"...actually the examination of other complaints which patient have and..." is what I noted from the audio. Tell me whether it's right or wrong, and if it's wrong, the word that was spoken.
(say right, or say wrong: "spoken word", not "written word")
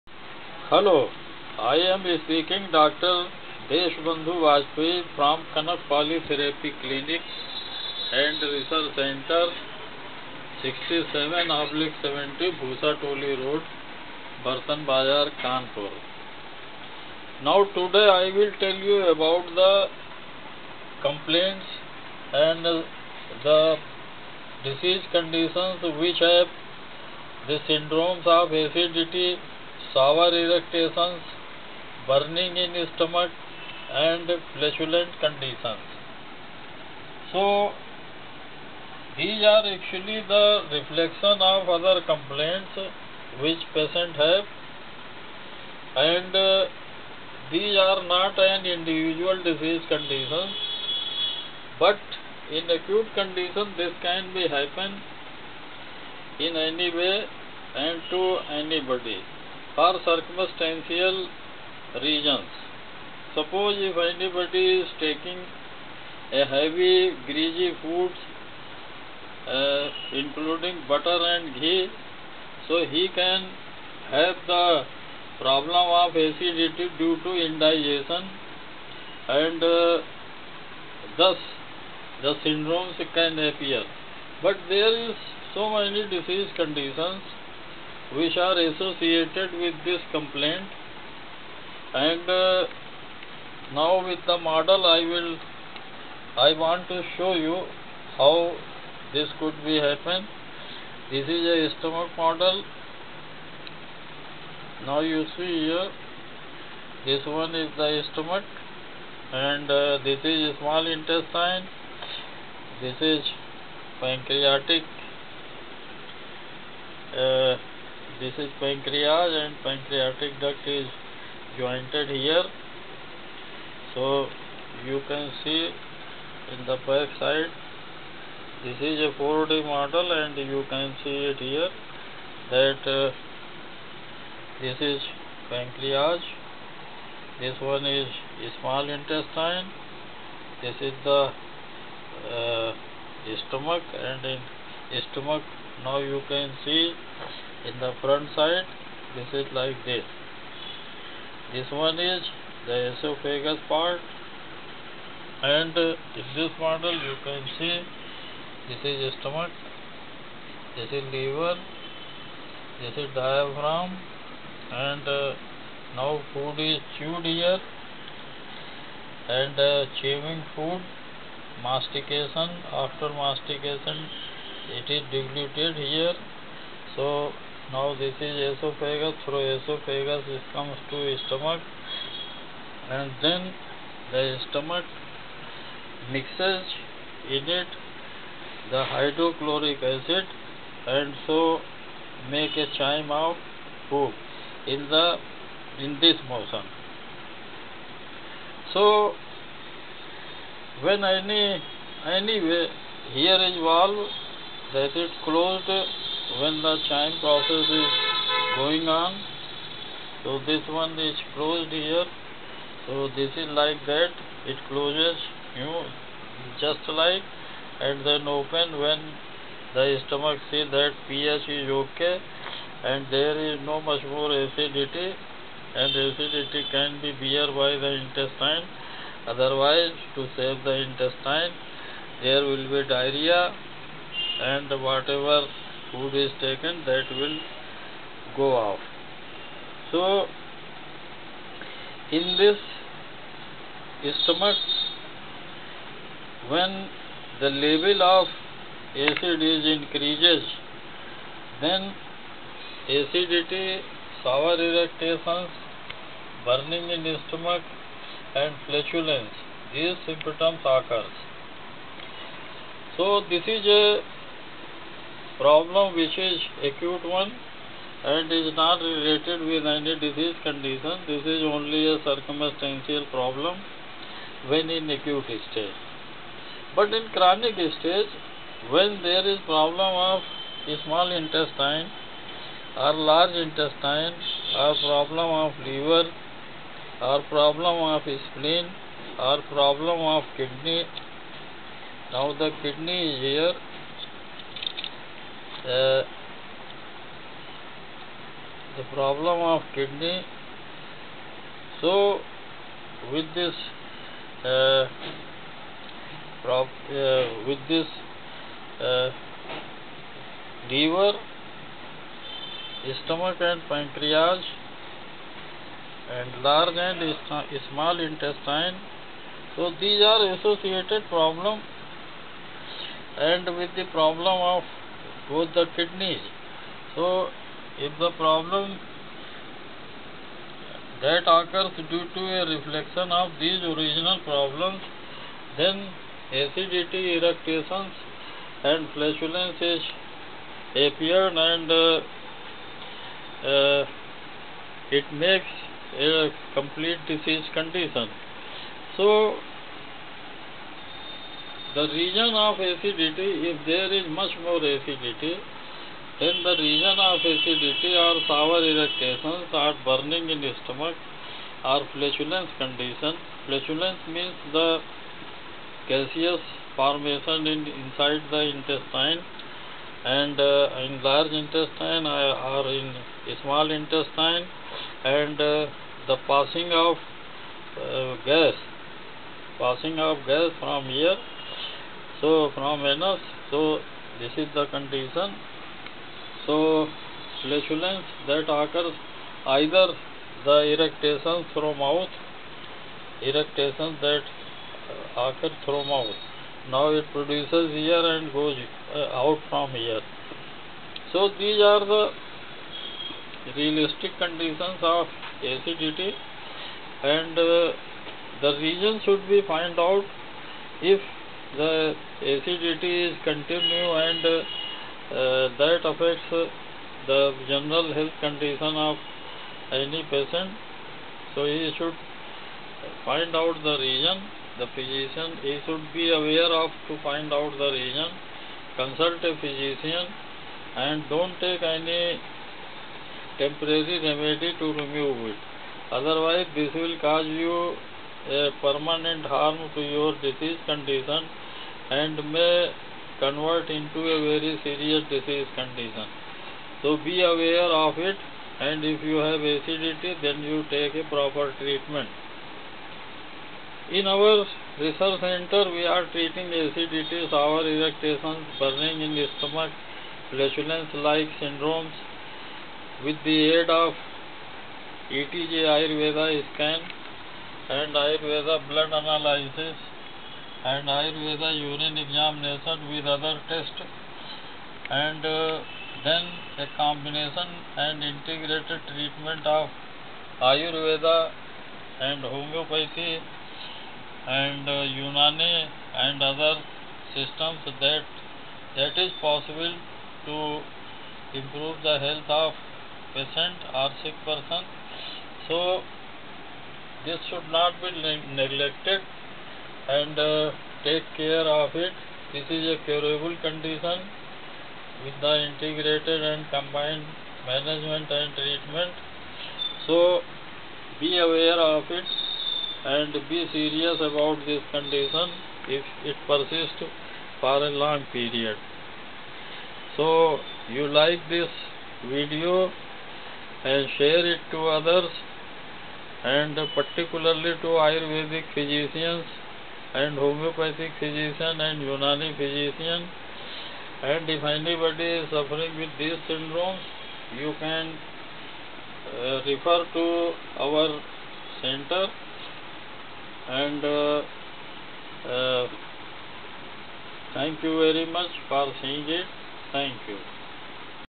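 wrong: "reflection", not "examination".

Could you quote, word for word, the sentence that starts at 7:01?
So he should find out the reason.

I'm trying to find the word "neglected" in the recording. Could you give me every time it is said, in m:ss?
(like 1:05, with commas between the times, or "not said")
8:18.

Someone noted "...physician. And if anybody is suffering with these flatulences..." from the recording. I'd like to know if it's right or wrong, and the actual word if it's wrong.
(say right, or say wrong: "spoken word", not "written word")
wrong: "syndromes", not "flatulences".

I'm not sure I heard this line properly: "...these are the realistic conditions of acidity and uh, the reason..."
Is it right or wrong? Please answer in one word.
right.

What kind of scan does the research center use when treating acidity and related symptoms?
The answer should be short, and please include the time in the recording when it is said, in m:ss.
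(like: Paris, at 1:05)
ETG Ayurveda scan, at 7:45.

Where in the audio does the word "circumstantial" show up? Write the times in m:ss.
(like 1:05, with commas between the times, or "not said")
1:00, 4:32.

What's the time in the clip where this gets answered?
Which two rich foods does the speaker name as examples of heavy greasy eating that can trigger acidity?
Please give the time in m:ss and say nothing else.
1:10.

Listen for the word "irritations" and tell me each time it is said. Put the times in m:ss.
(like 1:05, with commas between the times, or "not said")
4:14, 5:58, 7:37.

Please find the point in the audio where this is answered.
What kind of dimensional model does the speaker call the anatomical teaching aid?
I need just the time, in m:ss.
2:09.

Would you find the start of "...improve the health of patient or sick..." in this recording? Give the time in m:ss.
8:11.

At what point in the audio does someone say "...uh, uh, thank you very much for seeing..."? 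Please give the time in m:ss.
9:03.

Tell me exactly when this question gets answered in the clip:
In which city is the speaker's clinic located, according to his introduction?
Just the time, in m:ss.
0:15.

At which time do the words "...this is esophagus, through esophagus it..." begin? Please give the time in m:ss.
2:57.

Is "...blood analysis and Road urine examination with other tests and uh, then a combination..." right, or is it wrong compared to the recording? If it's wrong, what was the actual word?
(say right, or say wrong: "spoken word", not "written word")
wrong: "Ayurveda", not "Road".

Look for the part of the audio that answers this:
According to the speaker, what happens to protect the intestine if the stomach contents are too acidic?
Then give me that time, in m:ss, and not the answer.
3:52.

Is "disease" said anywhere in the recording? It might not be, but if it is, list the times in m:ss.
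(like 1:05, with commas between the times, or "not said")
0:24, 0:49, 1:26, 4:29, 5:47, 7:20, 7:25.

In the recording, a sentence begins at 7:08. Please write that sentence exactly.
Consult a physician and don't take any temporary remedy to remove it.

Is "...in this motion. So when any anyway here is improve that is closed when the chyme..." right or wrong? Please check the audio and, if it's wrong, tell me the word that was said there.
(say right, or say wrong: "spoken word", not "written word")
wrong: "valve", not "improve".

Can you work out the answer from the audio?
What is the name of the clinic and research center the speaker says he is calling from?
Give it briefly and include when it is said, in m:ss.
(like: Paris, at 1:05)
Kanak Polytherapy Clinic, at 0:05.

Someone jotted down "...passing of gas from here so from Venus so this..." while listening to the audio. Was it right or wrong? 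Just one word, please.
right.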